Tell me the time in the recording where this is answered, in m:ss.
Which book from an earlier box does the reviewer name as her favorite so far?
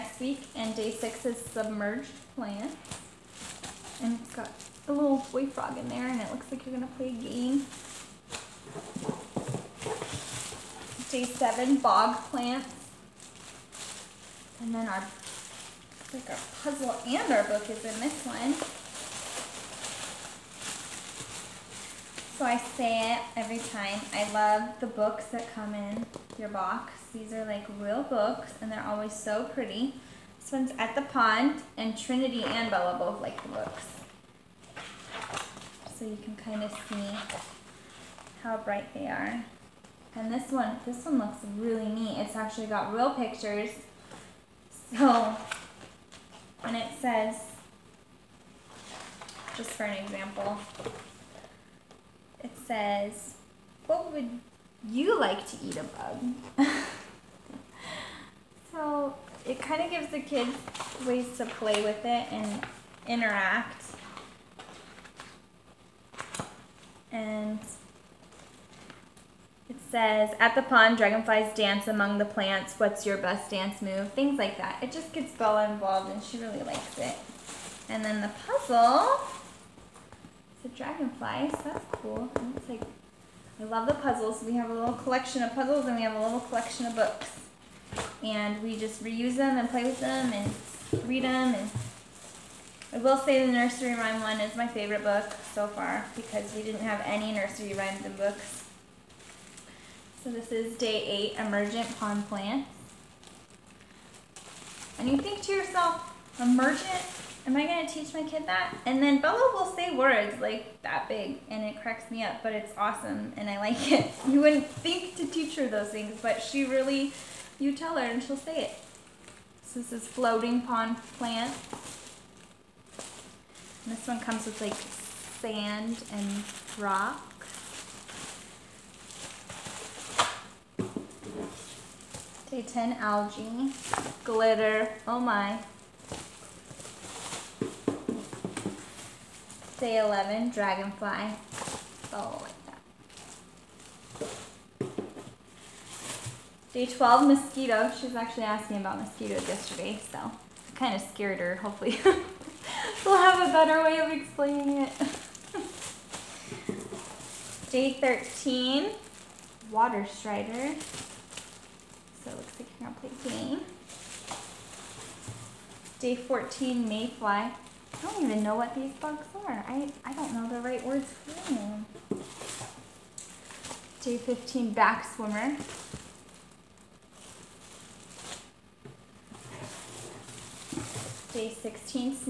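1:33.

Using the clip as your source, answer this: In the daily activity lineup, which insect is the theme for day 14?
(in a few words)
Mayfly.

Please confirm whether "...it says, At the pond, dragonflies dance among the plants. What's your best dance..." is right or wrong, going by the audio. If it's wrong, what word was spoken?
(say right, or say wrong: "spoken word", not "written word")
right.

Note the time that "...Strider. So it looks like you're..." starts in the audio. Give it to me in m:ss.
2:40.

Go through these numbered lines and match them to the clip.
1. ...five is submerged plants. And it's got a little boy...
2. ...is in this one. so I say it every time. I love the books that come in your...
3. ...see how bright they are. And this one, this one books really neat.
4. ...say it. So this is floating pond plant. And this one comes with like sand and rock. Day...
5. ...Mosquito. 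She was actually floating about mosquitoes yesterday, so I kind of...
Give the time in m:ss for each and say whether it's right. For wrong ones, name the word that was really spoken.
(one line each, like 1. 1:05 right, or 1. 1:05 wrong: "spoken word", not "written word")
1. 0:00 wrong: "six", not "five"
2. 0:17 right
3. 0:36 wrong: "looks", not "books"
4. 1:58 right
5. 2:27 wrong: "asking", not "floating".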